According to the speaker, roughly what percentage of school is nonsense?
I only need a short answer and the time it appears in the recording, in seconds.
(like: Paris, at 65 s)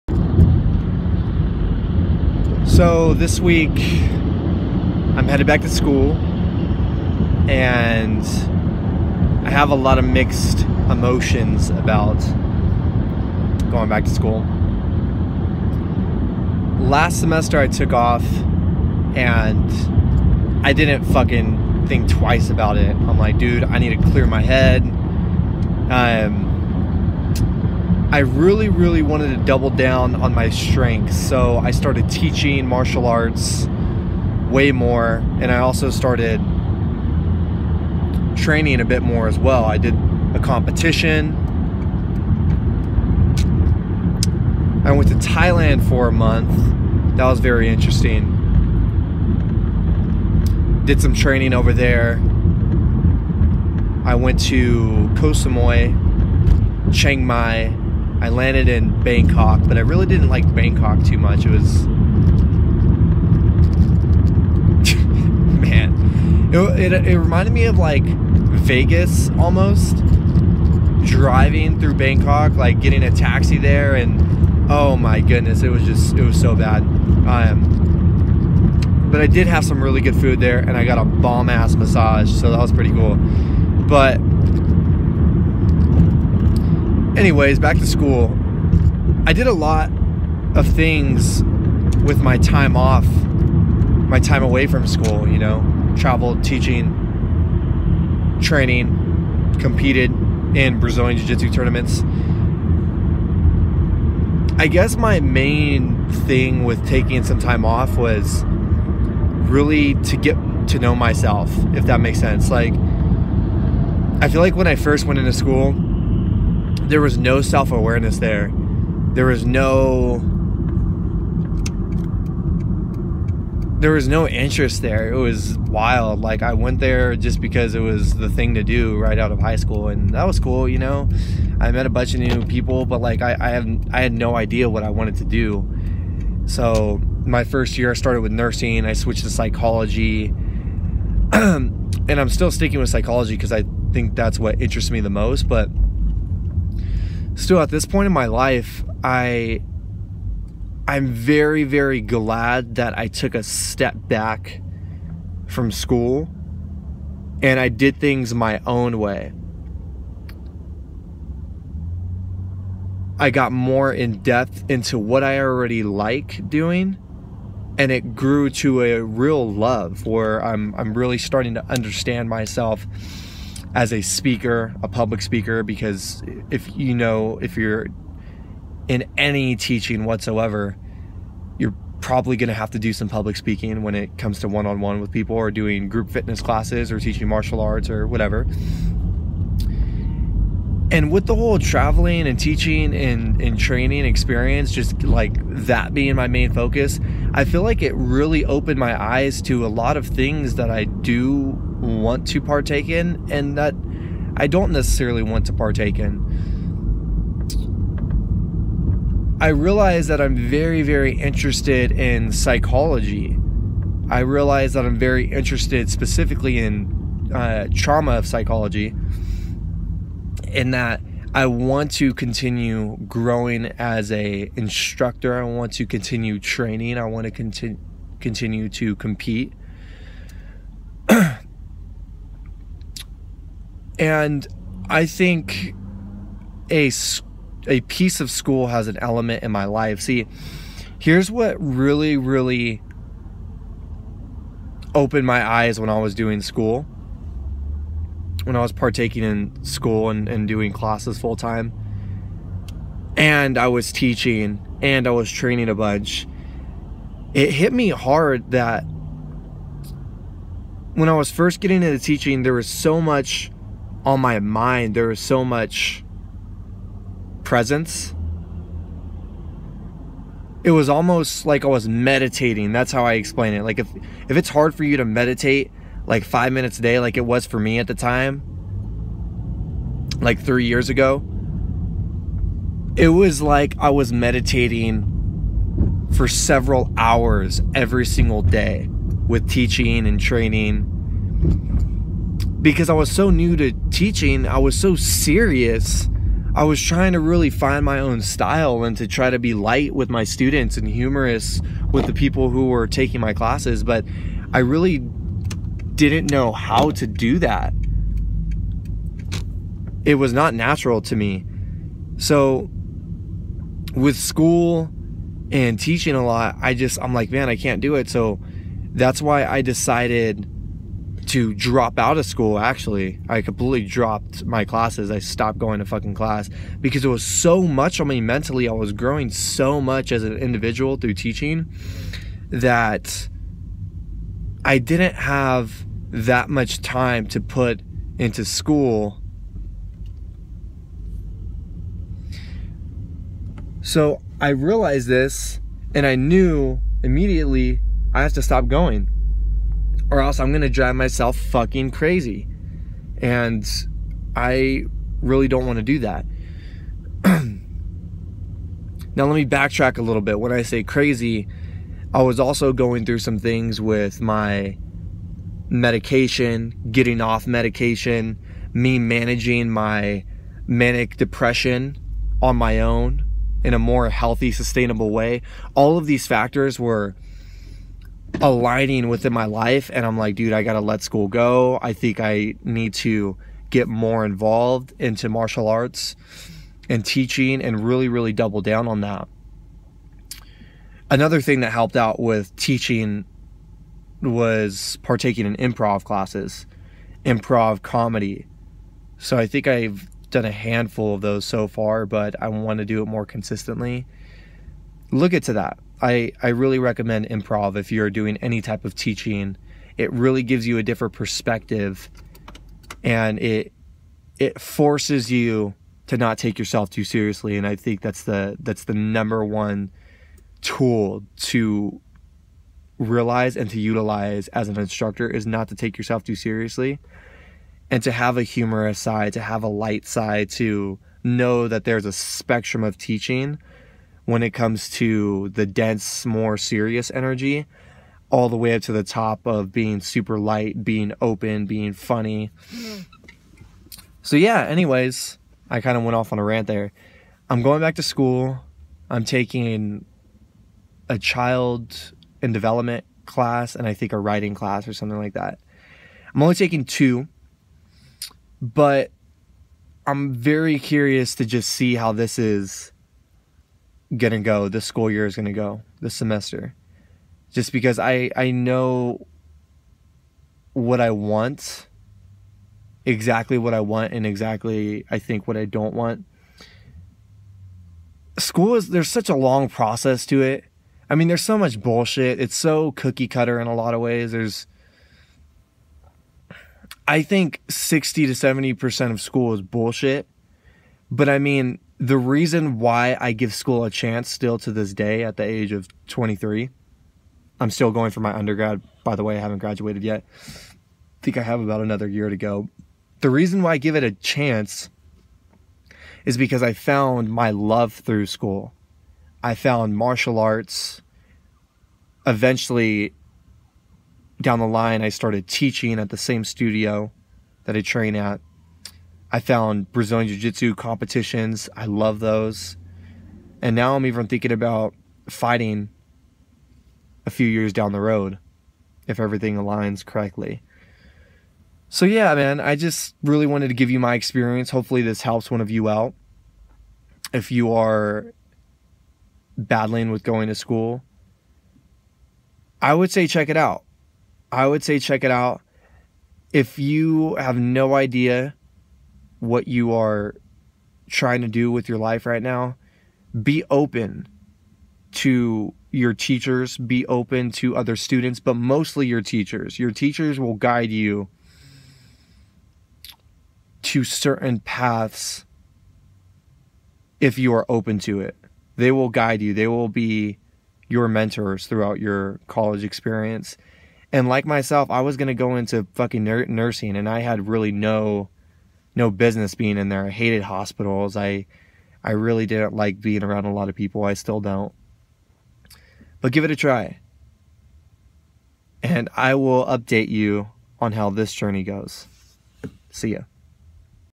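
60 to 70%, at 487 s.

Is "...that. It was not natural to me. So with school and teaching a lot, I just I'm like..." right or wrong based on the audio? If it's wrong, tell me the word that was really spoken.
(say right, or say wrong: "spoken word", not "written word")
right.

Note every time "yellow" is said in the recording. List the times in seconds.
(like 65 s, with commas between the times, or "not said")
not said.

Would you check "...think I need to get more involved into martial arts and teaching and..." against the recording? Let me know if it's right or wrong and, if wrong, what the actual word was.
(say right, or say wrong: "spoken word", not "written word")
right.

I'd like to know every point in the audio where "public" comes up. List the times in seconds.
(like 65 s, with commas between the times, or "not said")
174 s, 183 s.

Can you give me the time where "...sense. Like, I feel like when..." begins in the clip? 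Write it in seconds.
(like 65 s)
112 s.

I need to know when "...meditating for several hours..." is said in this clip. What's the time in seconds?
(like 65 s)
284 s.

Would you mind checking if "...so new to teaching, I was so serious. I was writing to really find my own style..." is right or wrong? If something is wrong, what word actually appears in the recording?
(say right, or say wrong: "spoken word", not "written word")
wrong: "trying", not "writing".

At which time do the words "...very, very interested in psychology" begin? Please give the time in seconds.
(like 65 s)
210 s.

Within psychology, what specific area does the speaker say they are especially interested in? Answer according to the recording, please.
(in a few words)
trauma.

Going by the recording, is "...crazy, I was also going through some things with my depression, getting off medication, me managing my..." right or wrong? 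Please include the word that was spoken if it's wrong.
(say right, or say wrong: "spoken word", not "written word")
wrong: "medication", not "depression".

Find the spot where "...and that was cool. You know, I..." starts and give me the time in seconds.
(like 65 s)
129 s.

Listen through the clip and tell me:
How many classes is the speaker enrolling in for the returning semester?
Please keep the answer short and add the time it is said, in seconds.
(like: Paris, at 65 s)
2, at 456 s.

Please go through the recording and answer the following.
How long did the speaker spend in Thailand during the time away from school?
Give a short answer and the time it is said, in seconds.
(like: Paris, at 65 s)
a month, at 46 s.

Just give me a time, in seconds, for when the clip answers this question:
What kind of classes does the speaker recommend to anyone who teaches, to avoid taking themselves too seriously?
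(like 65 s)
397 s.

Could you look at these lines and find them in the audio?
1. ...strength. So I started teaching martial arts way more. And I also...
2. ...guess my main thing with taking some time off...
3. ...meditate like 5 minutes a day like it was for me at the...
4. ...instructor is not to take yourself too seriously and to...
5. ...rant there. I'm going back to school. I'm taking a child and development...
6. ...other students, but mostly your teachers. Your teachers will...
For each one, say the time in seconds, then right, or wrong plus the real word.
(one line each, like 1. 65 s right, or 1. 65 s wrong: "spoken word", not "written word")
1. 30 s right
2. 104 s right
3. 275 s right
4. 424 s right
5. 446 s right
6. 557 s right.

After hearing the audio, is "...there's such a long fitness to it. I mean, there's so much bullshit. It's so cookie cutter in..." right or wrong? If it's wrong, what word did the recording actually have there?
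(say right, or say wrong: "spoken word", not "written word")
wrong: "process", not "fitness".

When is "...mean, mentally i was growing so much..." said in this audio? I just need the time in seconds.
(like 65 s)
328 s.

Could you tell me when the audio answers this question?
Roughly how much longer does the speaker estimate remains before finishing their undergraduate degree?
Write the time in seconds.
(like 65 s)
501 s.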